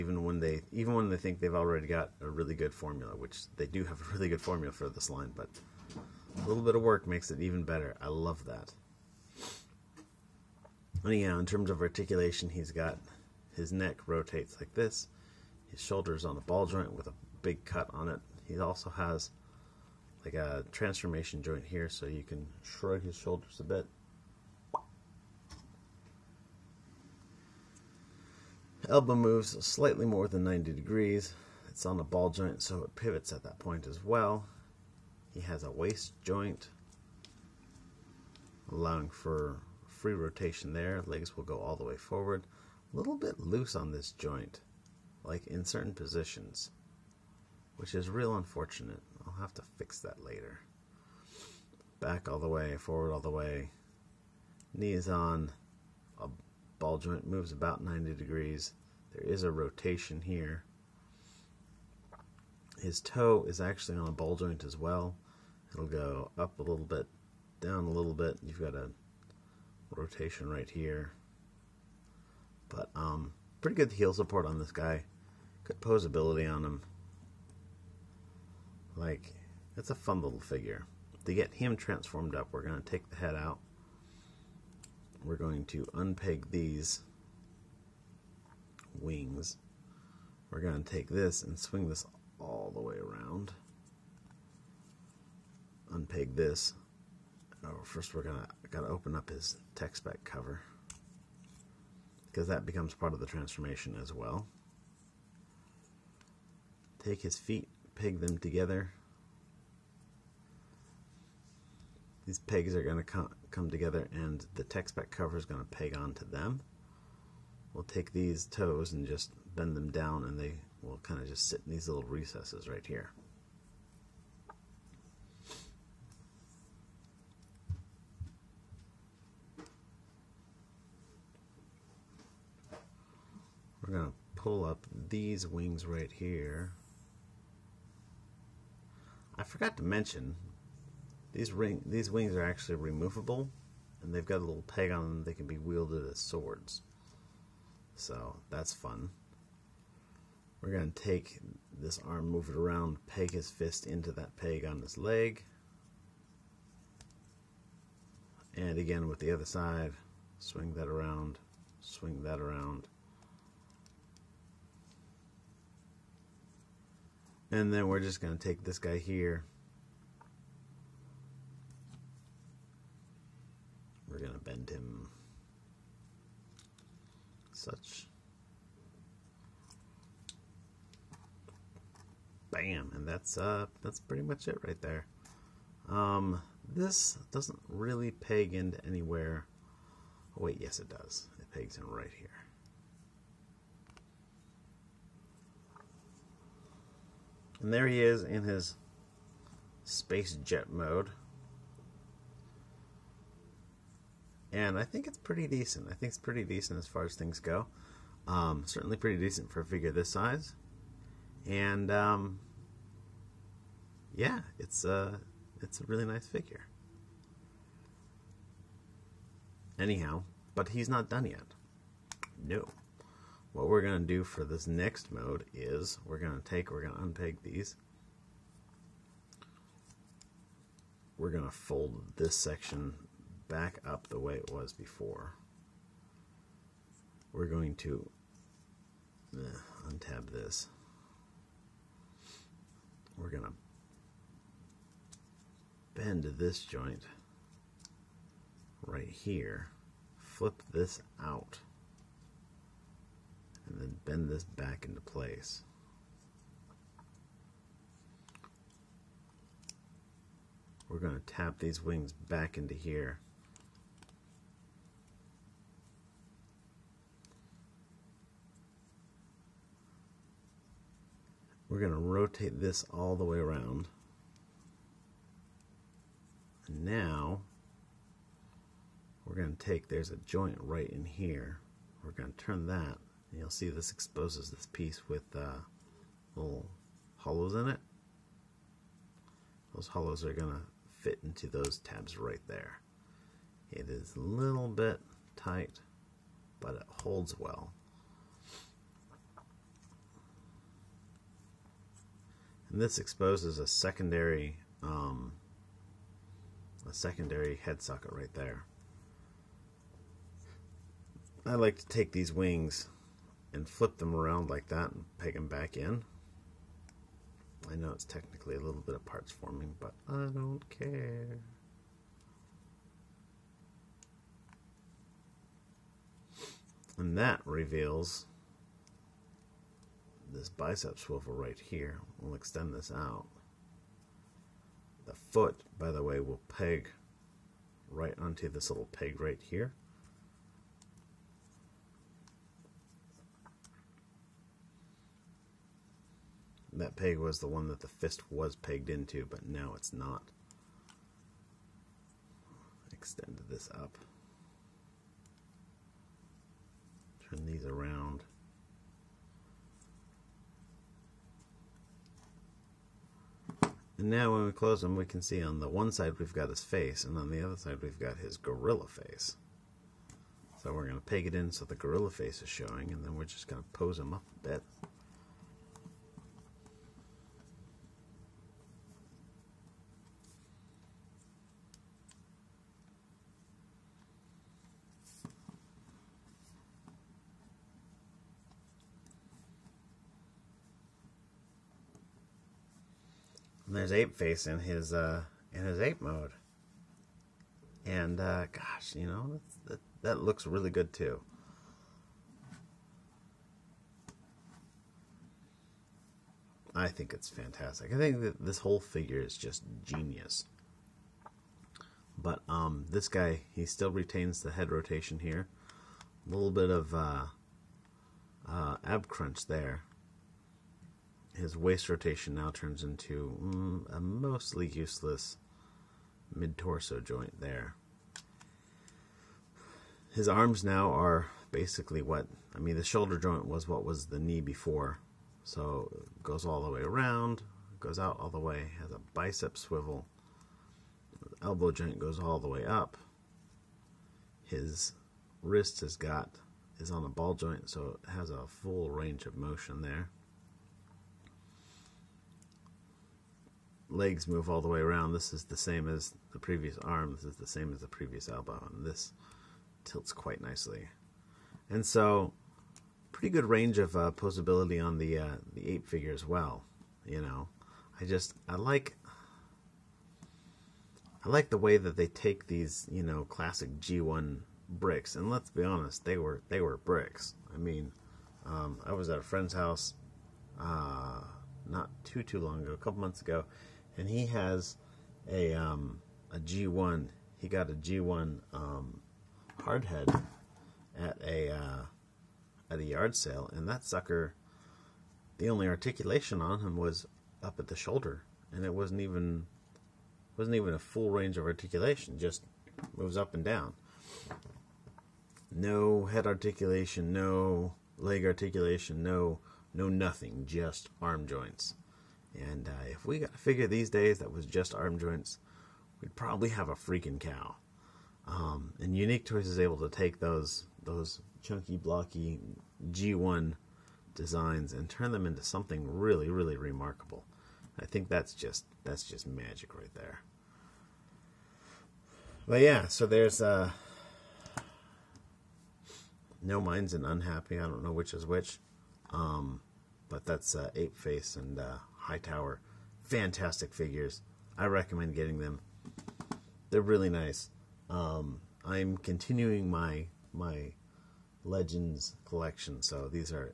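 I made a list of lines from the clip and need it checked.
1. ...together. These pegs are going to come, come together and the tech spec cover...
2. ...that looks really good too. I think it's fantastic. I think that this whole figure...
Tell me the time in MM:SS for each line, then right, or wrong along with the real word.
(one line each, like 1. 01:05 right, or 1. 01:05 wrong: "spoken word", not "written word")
1. 01:48 right
2. 06:40 right.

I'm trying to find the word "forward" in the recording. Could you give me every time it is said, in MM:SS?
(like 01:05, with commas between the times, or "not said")
00:41, 00:52.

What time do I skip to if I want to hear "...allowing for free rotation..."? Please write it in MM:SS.
00:38.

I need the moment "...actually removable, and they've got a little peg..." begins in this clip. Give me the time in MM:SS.
02:22.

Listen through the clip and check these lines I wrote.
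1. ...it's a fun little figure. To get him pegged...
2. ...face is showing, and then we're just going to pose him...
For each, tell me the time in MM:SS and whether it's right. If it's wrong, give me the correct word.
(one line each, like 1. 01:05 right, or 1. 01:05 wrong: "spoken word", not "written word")
1. 01:19 wrong: "transformed", not "pegged"
2. 06:12 right.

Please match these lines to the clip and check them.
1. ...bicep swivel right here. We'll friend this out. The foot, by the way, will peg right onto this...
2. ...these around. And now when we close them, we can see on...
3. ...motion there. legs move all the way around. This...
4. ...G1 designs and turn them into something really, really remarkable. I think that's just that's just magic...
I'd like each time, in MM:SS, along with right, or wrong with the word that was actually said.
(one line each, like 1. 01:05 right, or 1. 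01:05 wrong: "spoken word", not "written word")
1. 05:30 wrong: "extend", not "friend"
2. 05:57 right
3. 07:29 right
4. 08:42 right.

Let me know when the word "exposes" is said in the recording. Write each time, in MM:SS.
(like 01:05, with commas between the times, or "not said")
04:43, 05:02.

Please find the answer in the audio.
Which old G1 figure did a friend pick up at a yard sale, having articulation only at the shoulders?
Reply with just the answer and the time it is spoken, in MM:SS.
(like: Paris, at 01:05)
Hardhead, at 08:09.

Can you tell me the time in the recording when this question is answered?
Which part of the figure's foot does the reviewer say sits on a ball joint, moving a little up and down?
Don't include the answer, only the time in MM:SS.
01:02.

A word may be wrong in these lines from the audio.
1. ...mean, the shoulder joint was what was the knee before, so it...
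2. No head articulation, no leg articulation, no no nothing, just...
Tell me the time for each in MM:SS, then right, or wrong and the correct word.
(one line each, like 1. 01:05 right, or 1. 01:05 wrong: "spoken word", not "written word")
1. 07:12 right
2. 08:25 right.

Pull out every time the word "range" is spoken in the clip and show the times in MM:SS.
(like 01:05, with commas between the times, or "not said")
07:28, 07:43, 08:21.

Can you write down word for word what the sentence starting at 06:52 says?
But um, this guy, he still retains the head rotation here.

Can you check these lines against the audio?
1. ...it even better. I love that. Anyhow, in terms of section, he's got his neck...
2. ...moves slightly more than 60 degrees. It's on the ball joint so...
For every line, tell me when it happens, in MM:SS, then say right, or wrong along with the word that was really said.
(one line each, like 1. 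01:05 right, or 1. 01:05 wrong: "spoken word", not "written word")
1. 00:07 wrong: "articulation", not "section"
2. 00:29 wrong: "90", not "60".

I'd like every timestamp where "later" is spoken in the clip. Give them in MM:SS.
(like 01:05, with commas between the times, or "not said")
00:50.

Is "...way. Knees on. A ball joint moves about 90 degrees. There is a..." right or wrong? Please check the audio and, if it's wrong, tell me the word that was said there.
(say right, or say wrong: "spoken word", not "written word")
right.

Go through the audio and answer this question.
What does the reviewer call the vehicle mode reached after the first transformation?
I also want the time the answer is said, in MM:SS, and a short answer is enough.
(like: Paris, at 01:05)
Space jet mode, at 03:19.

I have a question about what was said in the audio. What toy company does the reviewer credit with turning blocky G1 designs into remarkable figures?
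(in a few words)
Unique Toys.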